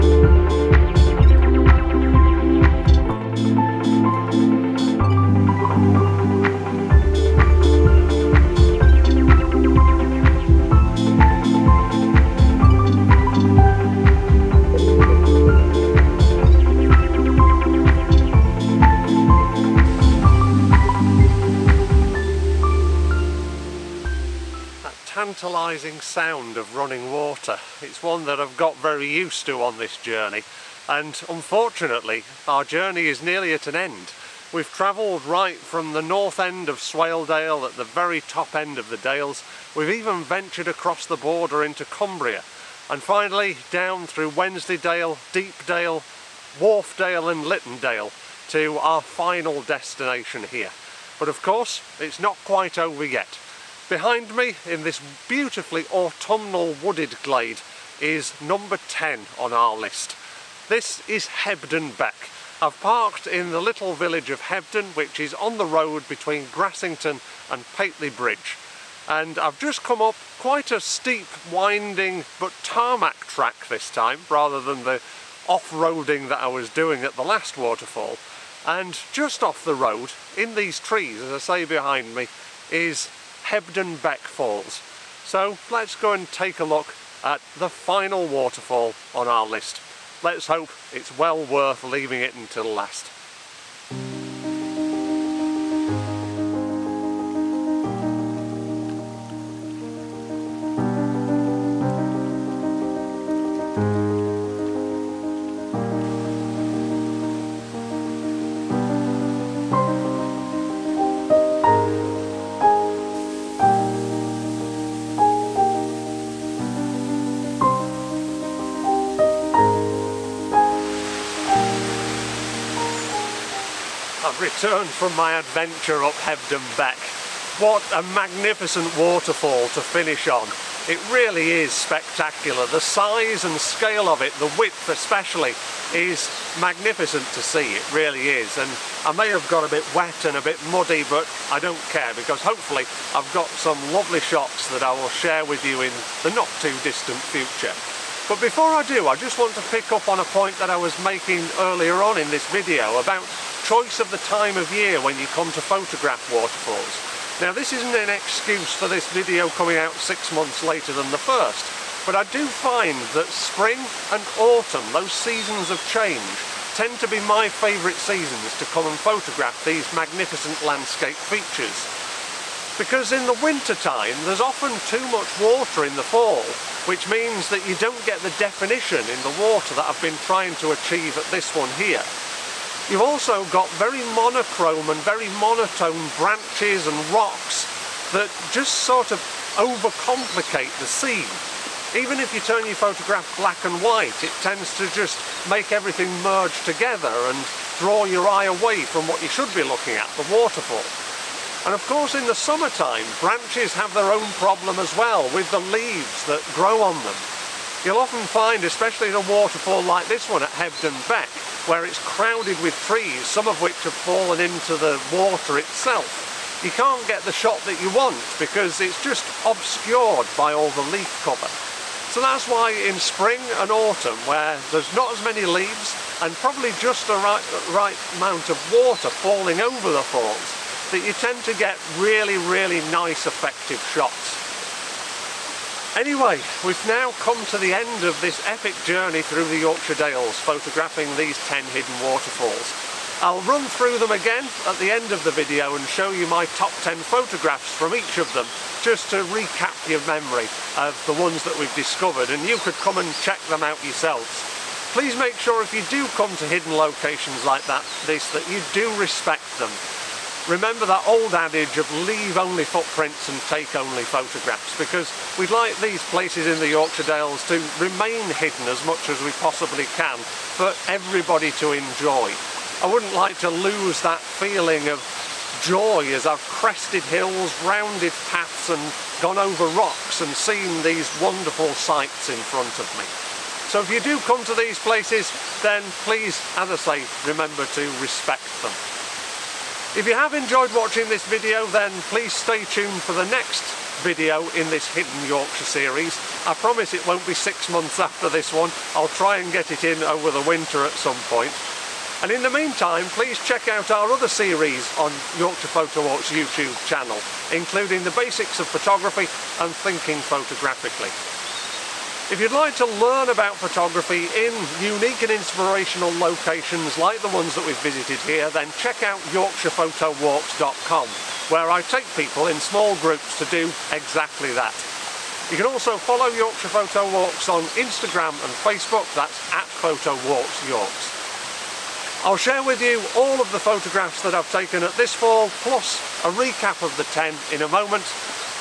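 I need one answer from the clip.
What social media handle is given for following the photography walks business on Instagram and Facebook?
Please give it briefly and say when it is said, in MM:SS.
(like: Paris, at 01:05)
Photo Walks Yorks, at 05:29.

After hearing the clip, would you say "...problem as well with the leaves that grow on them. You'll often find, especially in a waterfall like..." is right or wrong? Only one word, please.
right.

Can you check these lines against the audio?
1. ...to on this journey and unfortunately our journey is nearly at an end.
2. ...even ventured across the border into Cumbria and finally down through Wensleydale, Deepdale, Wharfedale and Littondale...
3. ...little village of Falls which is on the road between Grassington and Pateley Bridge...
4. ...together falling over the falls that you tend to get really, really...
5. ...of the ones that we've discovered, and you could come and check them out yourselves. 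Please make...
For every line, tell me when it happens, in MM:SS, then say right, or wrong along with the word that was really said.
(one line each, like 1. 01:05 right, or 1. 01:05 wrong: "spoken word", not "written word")
1. 00:29 right
2. 00:39 right
3. 01:03 wrong: "Hebden", not "Falls"
4. 03:48 wrong: "water", not "together"
5. 04:10 right.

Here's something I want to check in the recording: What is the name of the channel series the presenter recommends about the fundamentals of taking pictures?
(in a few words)
The basics of photography.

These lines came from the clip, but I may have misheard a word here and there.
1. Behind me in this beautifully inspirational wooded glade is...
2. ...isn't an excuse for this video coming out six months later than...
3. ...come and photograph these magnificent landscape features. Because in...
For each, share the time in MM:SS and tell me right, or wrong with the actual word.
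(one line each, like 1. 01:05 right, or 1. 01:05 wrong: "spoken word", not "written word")
1. 00:53 wrong: "autumnal", not "inspirational"
2. 02:37 right
3. 02:48 right.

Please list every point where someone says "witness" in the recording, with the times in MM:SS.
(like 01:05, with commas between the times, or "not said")
not said.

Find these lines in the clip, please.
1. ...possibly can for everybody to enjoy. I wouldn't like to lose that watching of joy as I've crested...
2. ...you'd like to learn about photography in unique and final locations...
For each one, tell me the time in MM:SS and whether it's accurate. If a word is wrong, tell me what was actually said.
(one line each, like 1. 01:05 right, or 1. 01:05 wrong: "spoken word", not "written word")
1. 04:29 wrong: "feeling", not "watching"
2. 05:12 wrong: "inspirational", not "final".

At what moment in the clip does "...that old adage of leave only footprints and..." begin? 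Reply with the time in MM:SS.
04:20.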